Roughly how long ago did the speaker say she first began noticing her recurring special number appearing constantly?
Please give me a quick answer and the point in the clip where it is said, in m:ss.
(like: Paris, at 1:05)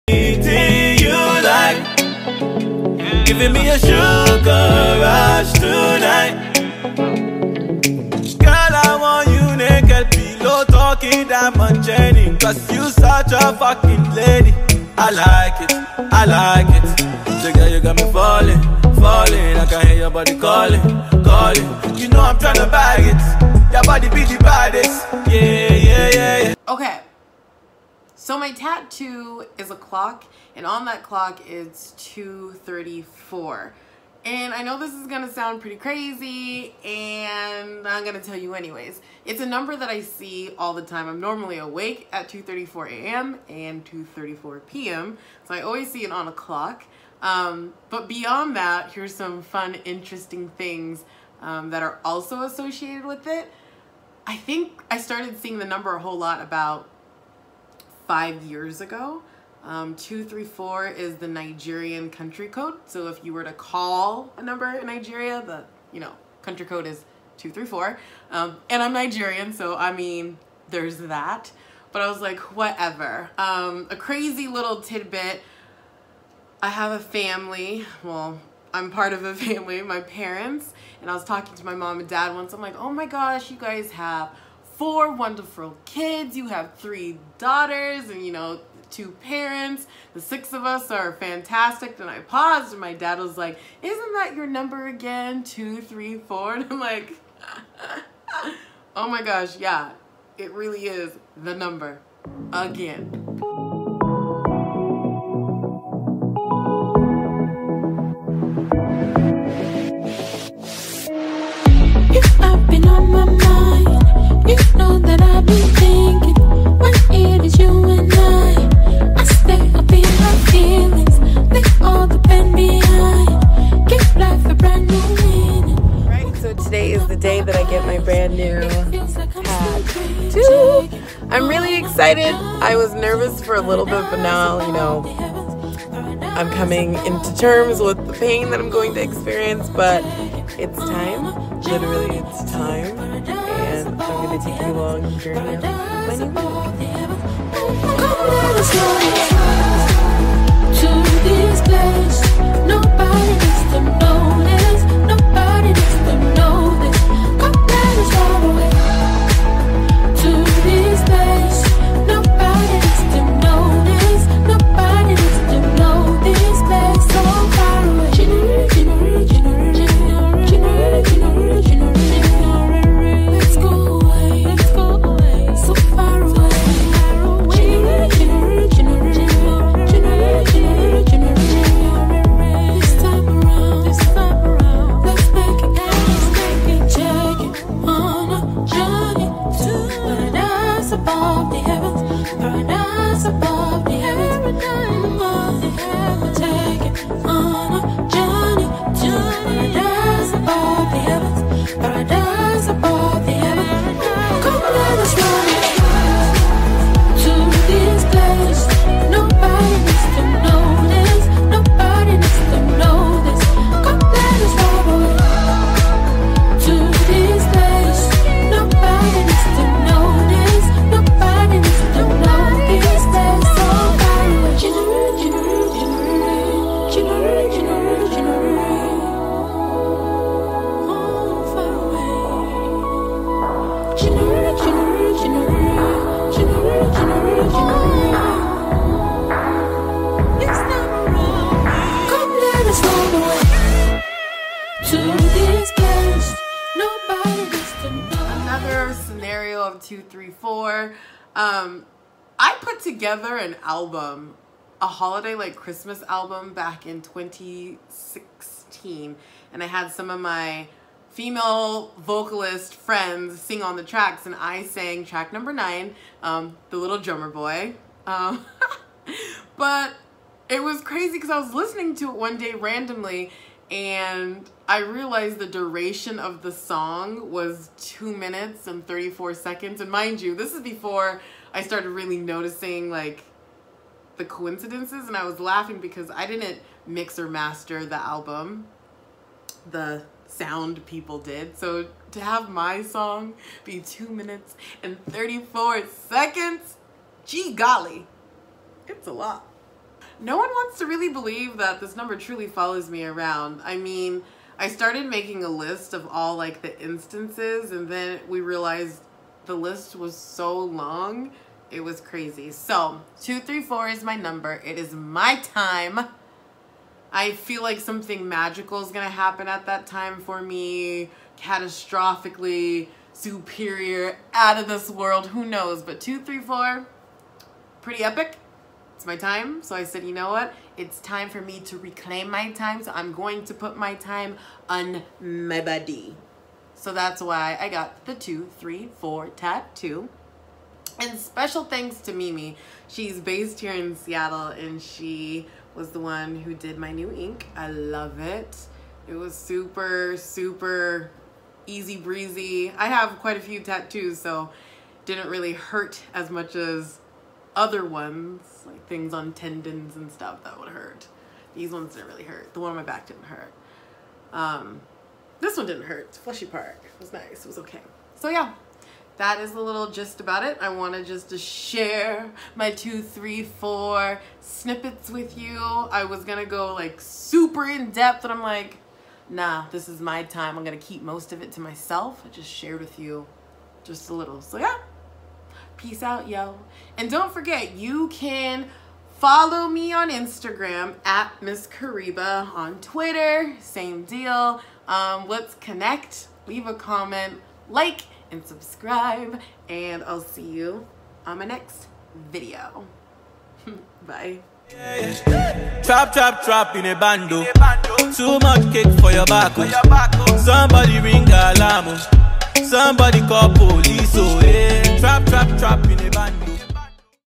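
5 years ago, at 0:58.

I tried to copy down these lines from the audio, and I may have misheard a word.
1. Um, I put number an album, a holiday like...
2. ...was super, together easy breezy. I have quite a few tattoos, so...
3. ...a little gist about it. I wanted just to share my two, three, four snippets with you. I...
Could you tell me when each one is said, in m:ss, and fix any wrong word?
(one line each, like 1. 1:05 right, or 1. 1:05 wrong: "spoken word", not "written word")
1. 4:11 wrong: "together", not "number"
2. 5:49 wrong: "super", not "together"
3. 6:09 right.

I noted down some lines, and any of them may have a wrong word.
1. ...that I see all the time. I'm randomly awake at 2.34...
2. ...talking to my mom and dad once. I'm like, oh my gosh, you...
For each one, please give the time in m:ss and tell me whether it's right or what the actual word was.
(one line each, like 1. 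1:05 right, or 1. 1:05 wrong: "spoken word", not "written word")
1. 0:39 wrong: "normally", not "randomly"
2. 1:21 right.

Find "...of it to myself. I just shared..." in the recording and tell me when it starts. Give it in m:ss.
6:21.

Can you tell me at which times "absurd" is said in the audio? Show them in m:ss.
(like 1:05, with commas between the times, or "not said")
not said.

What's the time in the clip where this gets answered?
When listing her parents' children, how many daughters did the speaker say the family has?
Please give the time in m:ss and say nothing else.
1:26.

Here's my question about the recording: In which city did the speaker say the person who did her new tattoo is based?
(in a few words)
Seattle.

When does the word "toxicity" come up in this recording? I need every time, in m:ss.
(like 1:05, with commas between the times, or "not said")
not said.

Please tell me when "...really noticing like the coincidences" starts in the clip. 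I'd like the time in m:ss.
4:41.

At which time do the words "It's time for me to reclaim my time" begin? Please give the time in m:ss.
5:30.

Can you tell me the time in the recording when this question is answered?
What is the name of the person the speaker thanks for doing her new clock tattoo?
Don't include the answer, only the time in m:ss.
5:42.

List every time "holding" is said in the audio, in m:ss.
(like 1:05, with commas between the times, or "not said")
not said.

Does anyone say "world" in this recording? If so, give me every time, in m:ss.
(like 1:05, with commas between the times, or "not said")
5:24.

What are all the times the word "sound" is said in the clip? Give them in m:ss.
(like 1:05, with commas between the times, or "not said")
0:35, 4:50.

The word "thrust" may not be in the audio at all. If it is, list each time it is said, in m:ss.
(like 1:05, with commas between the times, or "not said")
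not said.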